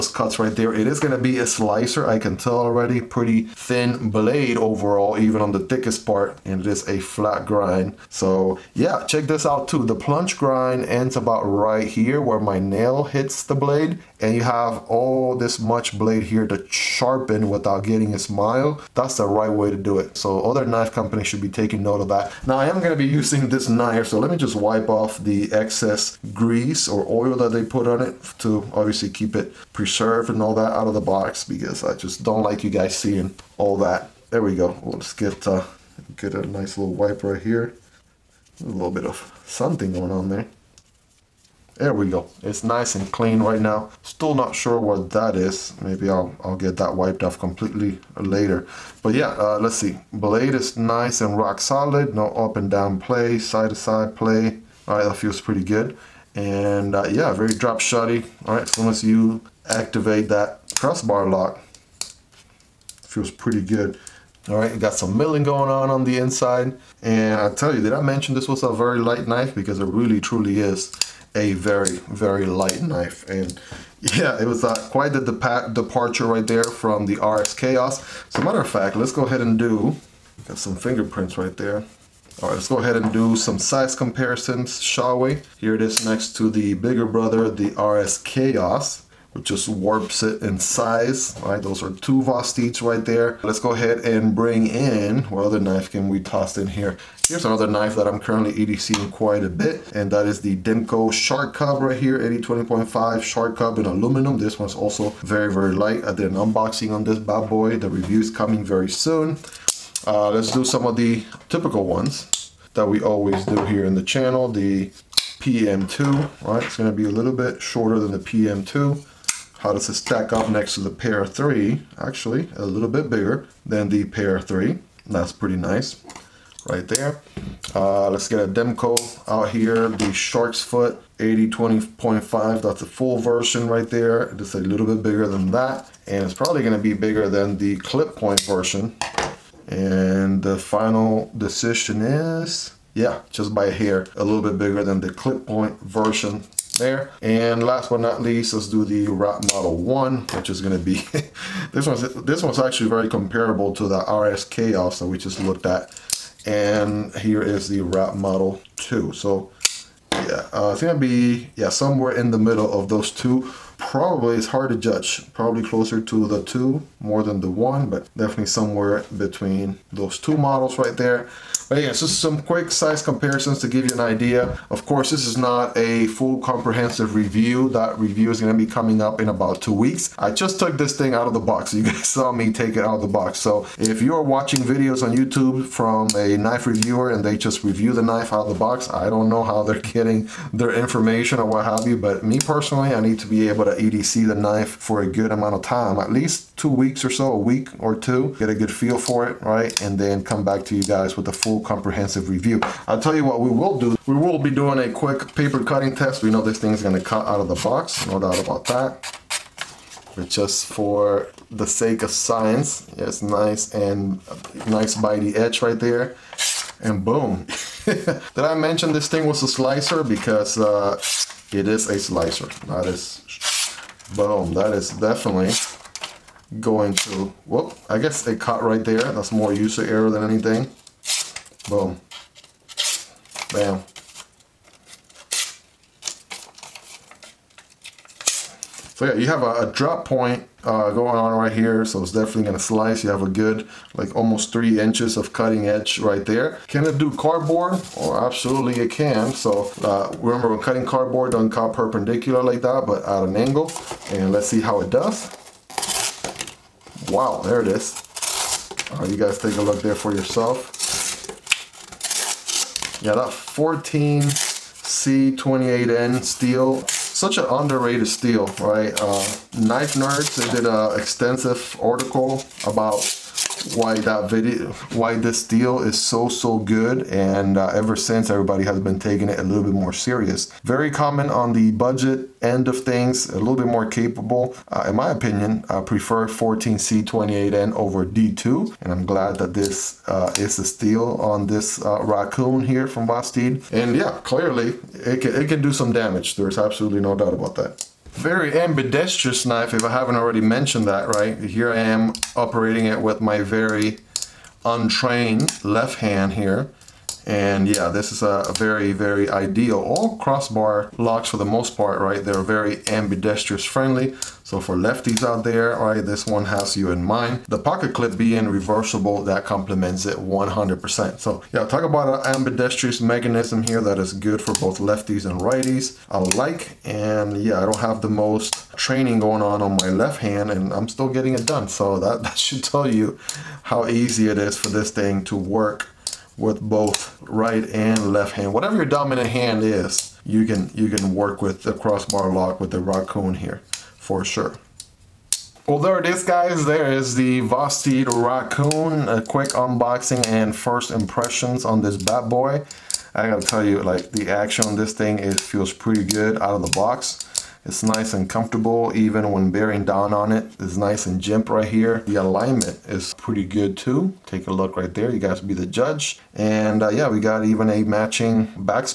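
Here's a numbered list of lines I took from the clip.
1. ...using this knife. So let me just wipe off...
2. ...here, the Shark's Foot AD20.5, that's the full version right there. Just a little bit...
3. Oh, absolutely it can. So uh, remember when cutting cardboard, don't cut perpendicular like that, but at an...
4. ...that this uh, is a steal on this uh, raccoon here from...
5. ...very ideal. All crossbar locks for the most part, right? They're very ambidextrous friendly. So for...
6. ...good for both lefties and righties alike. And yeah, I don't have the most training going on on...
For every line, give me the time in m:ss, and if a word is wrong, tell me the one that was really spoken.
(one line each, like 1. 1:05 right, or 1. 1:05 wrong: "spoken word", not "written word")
1. 0:23 right
2. 2:09 right
3. 4:07 right
4. 4:49 right
5. 5:08 right
6. 5:24 right.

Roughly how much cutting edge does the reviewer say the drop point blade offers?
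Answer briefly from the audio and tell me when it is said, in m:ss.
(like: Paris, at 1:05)
almost 3 inches, at 4:04.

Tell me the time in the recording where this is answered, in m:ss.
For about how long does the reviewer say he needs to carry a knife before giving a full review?
3:15.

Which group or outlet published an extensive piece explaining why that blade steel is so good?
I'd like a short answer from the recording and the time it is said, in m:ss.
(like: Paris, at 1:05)
Knife Nerds, at 4:29.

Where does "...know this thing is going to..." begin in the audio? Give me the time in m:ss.
3:26.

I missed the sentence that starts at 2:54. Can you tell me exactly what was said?
Of course, this is not a full comprehensive review.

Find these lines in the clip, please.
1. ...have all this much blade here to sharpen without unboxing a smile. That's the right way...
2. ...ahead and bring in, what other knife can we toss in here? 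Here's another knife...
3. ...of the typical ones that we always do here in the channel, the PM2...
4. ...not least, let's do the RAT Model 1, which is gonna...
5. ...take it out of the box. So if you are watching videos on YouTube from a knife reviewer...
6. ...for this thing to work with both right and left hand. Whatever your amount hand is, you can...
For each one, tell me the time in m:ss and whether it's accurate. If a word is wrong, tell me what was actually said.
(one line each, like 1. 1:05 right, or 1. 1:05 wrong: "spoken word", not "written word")
1. 0:14 wrong: "getting", not "unboxing"
2. 1:33 right
3. 1:50 right
4. 2:27 right
5. 3:02 right
6. 5:34 wrong: "dominant", not "amount".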